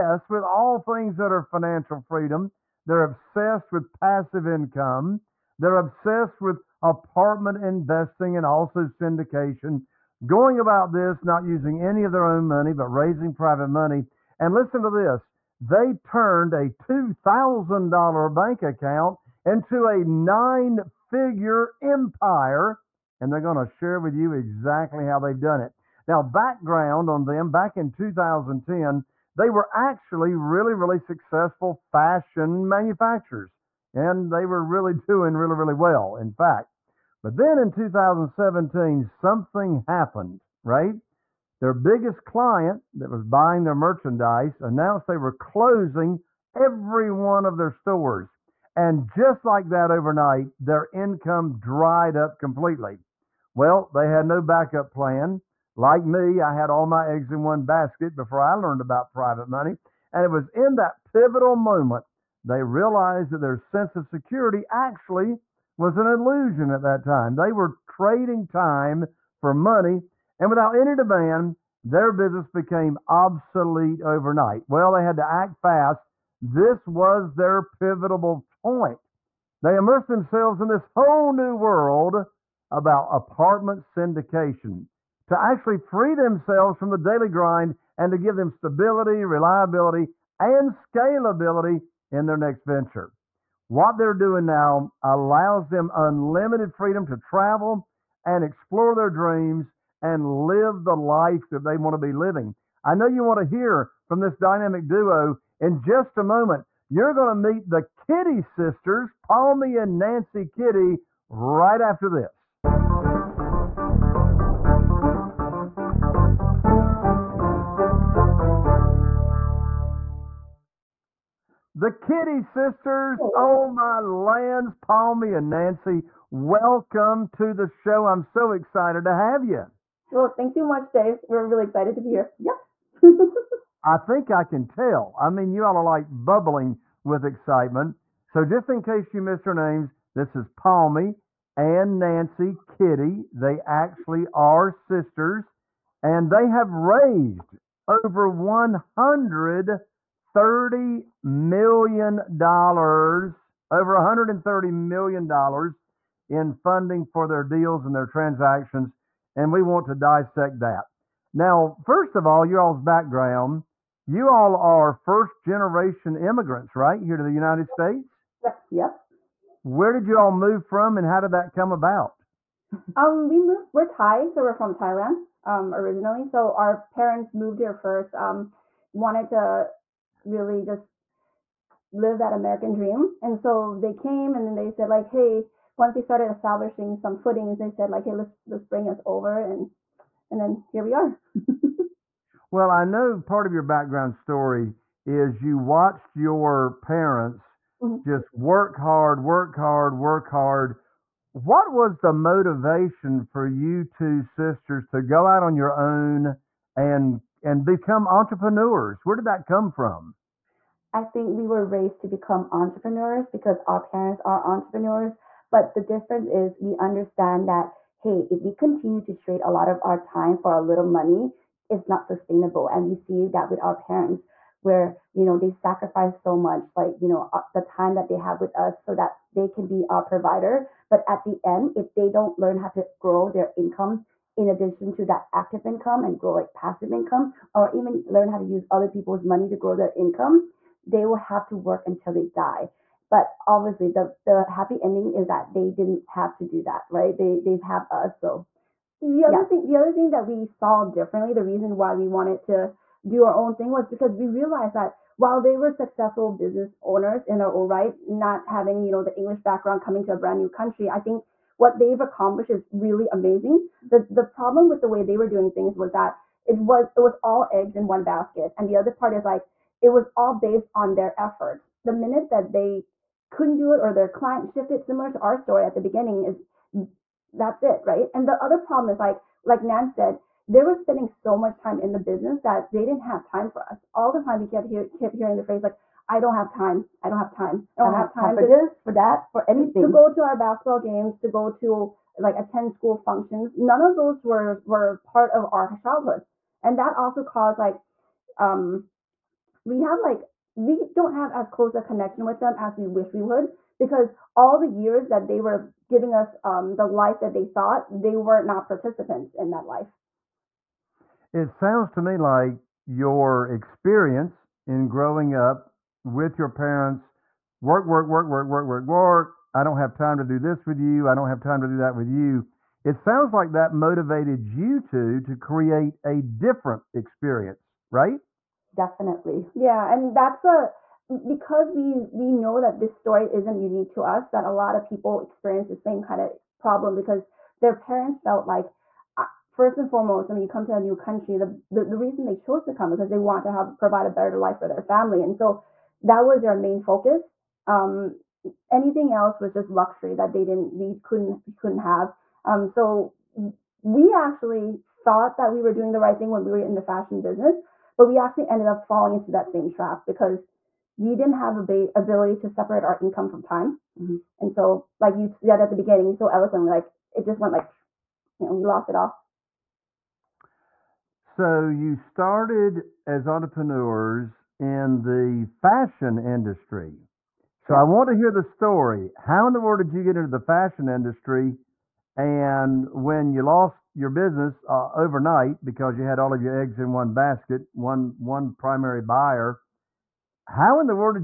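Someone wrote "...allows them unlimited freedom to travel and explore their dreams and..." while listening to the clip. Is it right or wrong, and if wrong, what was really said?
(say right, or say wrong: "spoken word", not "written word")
right.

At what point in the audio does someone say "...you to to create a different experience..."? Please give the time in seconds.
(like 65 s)
324 s.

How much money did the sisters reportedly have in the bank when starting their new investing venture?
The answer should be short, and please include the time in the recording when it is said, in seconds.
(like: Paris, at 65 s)
$2,000, at 16 s.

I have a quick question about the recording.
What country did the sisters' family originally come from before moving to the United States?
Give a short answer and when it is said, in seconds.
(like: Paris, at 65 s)
Thailand, at 174 s.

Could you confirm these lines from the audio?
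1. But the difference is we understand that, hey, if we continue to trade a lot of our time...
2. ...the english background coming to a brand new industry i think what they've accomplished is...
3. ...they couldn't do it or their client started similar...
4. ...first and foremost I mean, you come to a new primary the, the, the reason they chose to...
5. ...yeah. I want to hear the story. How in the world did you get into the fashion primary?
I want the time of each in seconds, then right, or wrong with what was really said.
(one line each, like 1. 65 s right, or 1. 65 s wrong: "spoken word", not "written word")
1. 215 s right
2. 259 s wrong: "country", not "industry"
3. 272 s wrong: "shifted", not "started"
4. 339 s wrong: "country", not "primary"
5. 377 s wrong: "industry", not "primary".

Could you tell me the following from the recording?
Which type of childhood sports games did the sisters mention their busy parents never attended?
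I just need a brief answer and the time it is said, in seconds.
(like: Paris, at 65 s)
basketball, at 290 s.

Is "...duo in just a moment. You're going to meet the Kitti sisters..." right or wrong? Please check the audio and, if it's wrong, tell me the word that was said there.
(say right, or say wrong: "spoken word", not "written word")
right.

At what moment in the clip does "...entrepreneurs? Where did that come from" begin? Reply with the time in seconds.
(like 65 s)
208 s.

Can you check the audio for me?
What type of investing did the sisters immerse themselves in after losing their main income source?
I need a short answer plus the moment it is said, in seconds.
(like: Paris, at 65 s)
apartment syndication, at 83 s.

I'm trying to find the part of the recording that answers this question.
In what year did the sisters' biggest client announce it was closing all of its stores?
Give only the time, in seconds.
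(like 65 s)
37 s.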